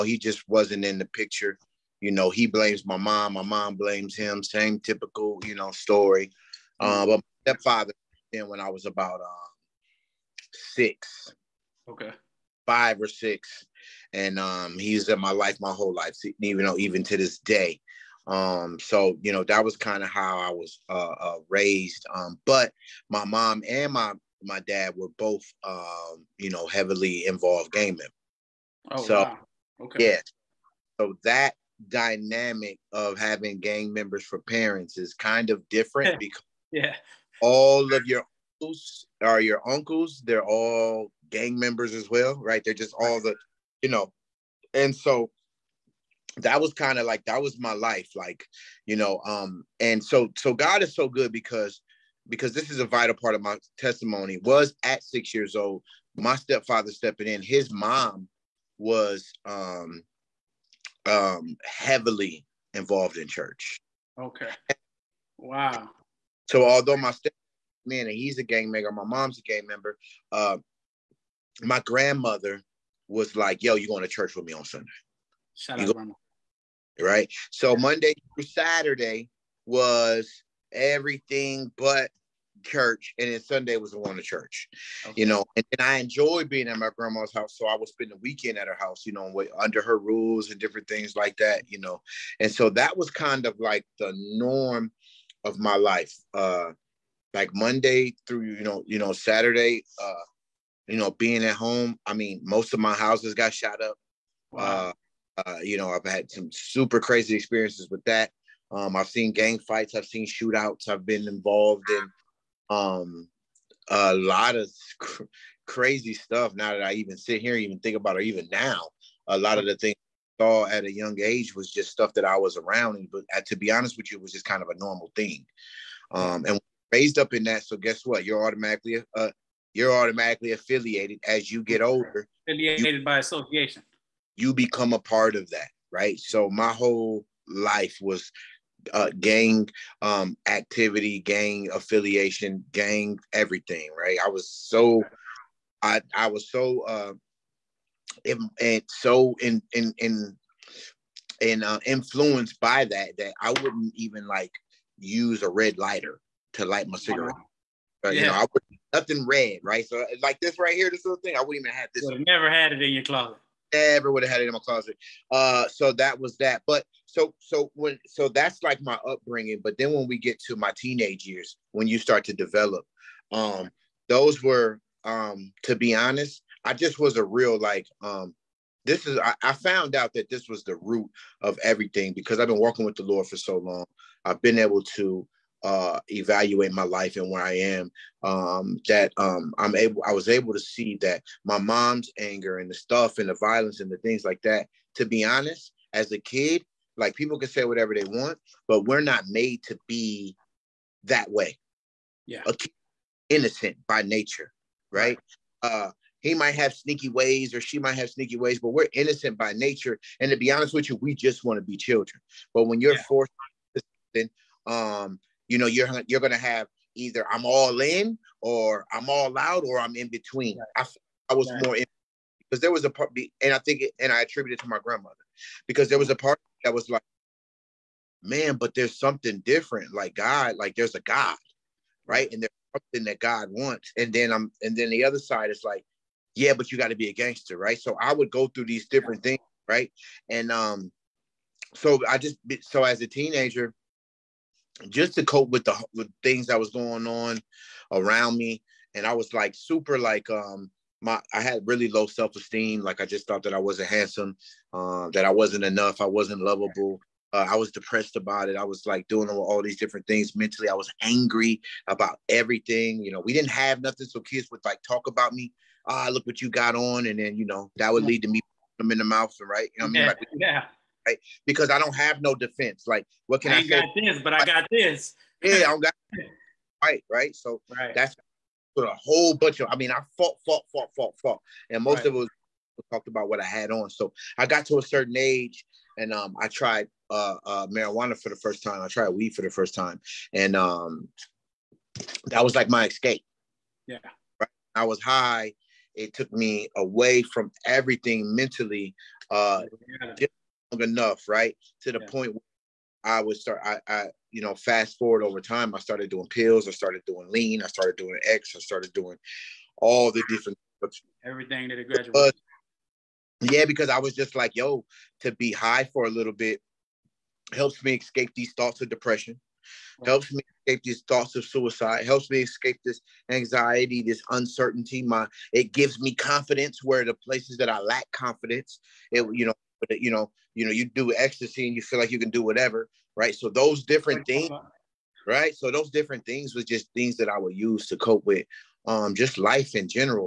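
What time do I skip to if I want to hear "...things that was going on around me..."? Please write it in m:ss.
4:06.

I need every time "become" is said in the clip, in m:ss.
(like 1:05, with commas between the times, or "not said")
2:14.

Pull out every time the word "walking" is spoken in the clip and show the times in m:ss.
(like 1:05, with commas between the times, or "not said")
3:02.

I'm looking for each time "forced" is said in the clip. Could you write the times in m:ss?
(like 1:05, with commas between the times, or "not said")
3:33.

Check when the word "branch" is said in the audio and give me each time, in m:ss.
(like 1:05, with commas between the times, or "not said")
not said.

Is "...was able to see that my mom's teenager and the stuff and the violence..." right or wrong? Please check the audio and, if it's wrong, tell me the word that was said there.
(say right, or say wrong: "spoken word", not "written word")
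wrong: "anger", not "teenager".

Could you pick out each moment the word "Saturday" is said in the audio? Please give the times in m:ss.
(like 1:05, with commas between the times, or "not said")
1:18, 1:39.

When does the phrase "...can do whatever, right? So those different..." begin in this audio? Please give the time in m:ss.
5:32.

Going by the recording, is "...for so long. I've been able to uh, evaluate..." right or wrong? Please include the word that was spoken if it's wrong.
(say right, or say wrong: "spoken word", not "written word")
right.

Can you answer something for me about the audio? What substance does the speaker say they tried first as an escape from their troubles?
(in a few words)
Marijuana.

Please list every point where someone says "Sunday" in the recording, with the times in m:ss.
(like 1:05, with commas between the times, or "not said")
1:14, 1:23.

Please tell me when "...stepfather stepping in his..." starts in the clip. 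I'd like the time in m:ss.
0:56.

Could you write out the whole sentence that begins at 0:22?
Um, but my mom and my my dad were both um, you know heavily involved gaming.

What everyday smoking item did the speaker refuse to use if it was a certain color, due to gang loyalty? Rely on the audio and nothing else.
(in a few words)
Red lighter.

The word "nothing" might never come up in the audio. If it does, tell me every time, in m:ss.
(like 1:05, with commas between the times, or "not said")
2:38, 4:23.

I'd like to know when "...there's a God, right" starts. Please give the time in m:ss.
3:50.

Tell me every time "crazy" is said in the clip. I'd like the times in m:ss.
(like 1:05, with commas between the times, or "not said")
1:46, 1:55.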